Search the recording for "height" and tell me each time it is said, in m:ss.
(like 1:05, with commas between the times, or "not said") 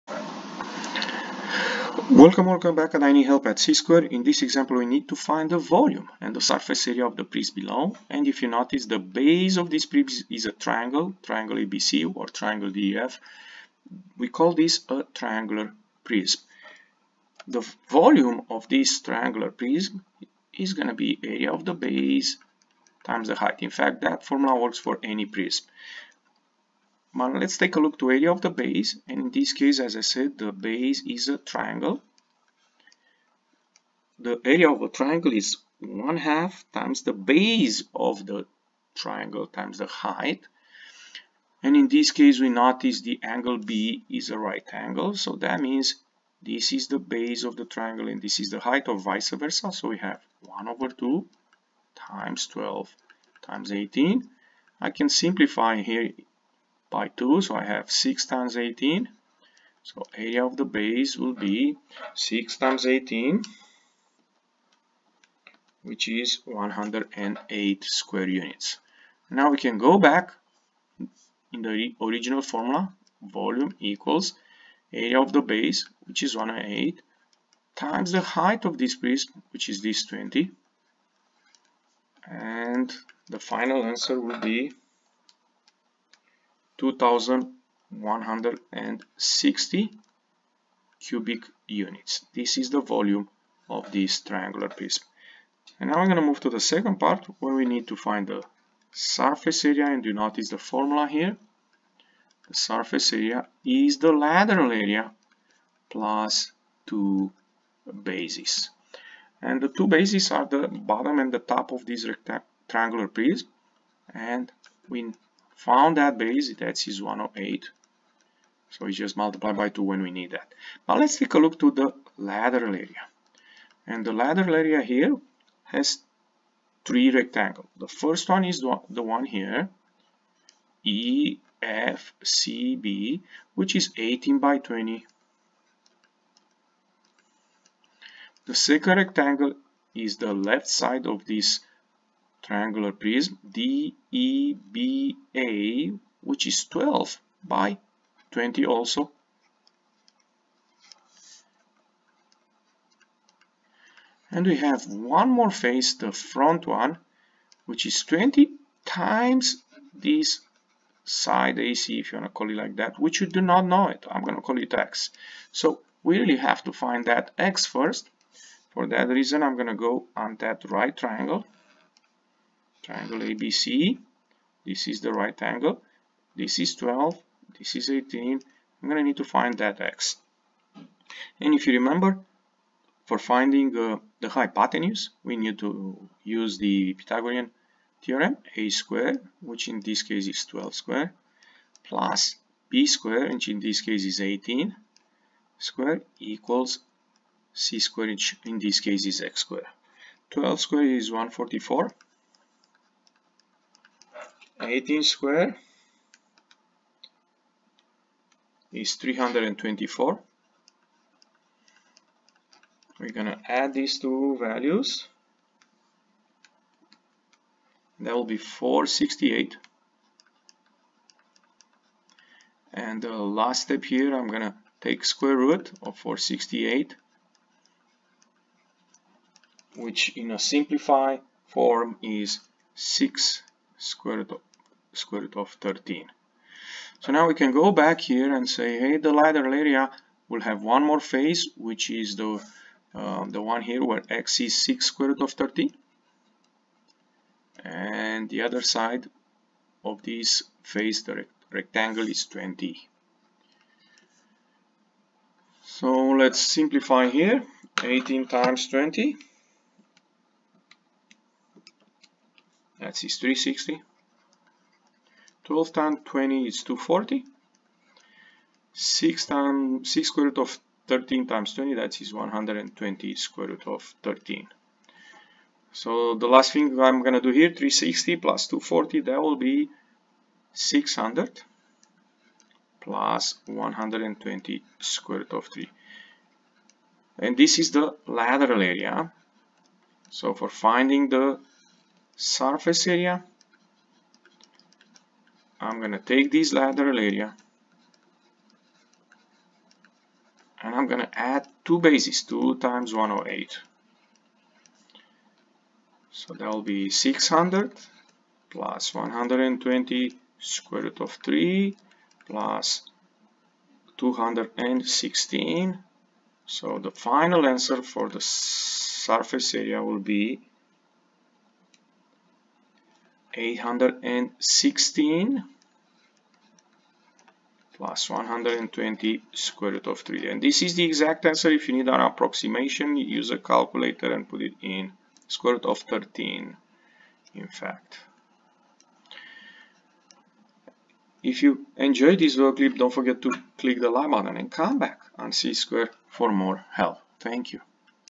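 0:23, 0:39, 0:48, 1:18.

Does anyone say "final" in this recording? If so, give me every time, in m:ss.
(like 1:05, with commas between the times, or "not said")
1:23, 5:16.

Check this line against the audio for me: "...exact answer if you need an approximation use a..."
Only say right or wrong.
right.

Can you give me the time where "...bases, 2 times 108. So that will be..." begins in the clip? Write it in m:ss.
5:01.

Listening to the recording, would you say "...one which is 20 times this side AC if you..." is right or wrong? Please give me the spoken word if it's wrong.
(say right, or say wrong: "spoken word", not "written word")
right.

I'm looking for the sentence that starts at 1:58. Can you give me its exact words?
So we just multiply by 2 when we need that.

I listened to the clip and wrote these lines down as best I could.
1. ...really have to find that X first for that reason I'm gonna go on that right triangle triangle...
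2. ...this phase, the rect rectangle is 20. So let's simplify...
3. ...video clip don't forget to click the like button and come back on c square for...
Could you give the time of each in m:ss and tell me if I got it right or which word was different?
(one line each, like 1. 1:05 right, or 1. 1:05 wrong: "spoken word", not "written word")
1. 2:46 right
2. 4:10 right
3. 5:42 right.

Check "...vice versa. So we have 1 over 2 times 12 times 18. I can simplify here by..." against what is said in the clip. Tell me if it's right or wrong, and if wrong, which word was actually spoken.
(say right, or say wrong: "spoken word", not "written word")
right.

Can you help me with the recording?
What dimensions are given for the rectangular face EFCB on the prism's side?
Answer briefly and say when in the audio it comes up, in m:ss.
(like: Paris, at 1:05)
18 by 20, at 2:13.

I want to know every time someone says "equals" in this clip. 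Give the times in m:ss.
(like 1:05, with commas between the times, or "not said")
1:13, 3:16.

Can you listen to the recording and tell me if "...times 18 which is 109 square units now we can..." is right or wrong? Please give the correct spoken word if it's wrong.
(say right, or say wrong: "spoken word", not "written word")
wrong: "108", not "109".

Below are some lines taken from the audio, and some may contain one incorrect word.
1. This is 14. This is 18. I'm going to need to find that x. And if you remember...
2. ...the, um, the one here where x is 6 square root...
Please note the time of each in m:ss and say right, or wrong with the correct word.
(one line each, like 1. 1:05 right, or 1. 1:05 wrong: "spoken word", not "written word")
1. 2:56 wrong: "12", not "14"
2. 4:02 right.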